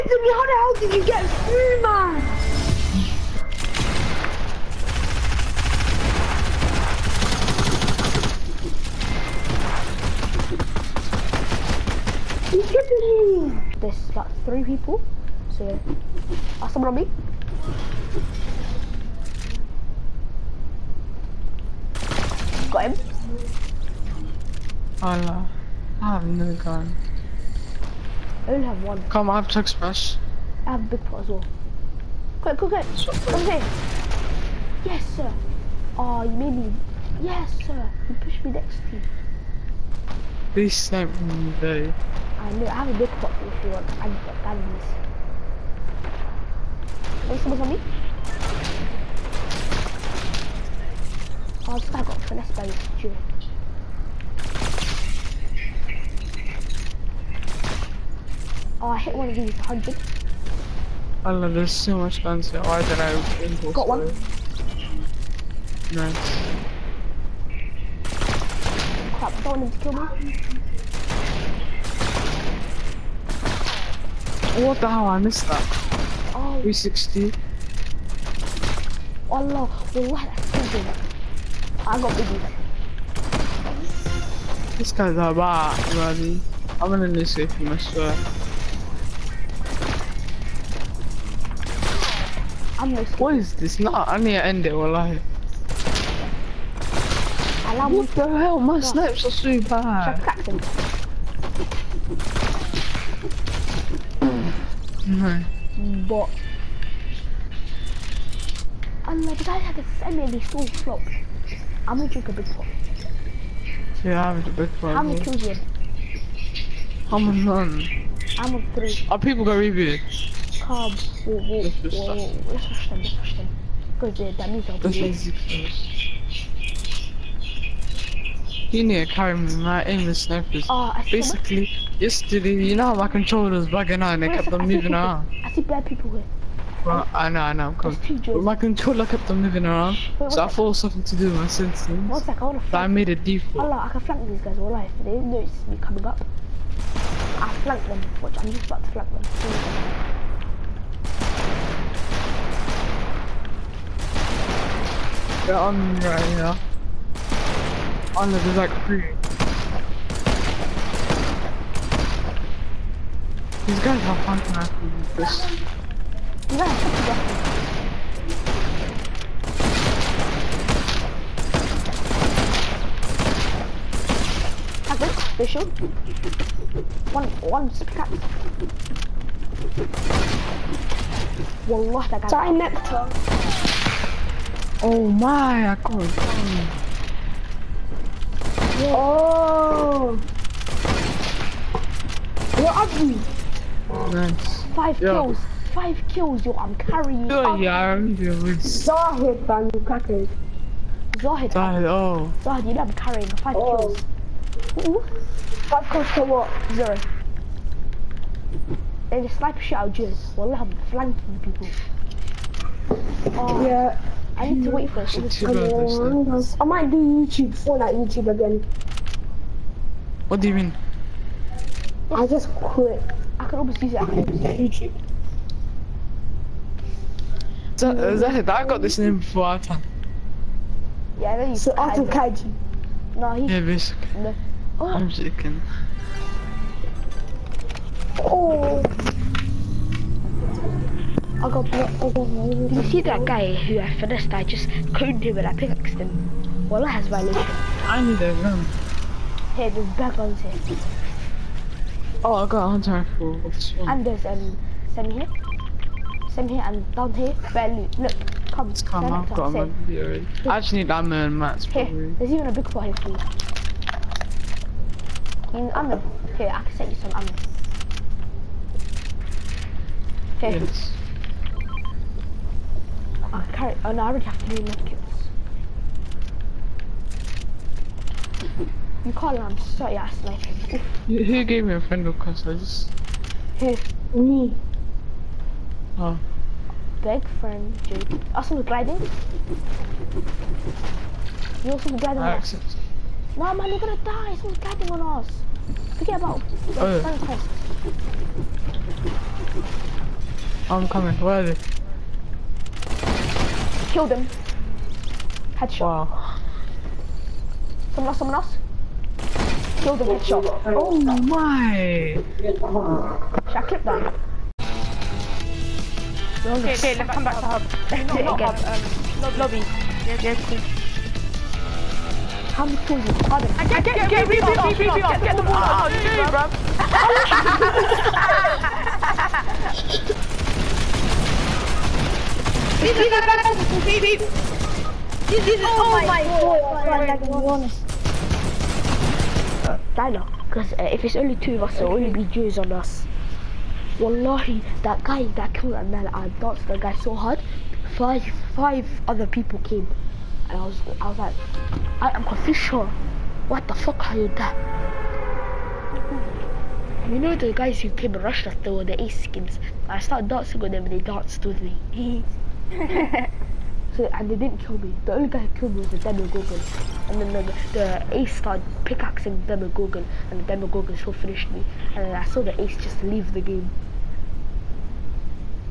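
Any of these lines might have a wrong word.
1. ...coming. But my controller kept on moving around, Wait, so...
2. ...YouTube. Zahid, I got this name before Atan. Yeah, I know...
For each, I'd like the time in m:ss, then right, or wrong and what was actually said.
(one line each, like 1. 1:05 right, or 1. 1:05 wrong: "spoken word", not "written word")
1. 2:17 right
2. 3:44 right.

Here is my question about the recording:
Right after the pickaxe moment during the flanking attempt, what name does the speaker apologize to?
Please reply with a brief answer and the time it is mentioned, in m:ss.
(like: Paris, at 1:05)
Nectar, at 3:02.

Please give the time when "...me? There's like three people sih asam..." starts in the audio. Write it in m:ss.
0:13.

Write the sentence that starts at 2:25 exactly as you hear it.
They didn't notice me coming up.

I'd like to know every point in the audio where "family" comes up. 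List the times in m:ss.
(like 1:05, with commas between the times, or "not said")
1:49.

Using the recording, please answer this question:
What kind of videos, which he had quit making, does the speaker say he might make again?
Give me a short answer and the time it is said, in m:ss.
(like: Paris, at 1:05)
Fortnite YouTube, at 3:37.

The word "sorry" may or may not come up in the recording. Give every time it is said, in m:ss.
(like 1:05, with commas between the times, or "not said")
3:02, 4:39.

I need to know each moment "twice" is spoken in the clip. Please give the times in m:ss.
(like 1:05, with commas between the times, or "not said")
not said.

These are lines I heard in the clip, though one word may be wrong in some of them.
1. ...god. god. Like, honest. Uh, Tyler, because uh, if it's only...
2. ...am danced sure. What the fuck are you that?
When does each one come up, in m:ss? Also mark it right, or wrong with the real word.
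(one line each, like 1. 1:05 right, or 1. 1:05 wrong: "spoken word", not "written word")
1. 5:36 right
2. 5:52 wrong: "confused", not "danced".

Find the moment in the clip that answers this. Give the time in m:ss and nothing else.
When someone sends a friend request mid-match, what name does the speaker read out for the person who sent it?
4:47.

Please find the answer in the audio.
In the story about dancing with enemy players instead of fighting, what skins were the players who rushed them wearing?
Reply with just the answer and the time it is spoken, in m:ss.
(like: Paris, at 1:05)
ace skins, at 5:59.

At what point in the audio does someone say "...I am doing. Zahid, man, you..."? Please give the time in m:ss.
3:17.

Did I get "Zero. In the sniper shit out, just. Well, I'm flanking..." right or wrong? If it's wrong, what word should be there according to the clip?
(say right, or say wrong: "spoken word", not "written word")
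right.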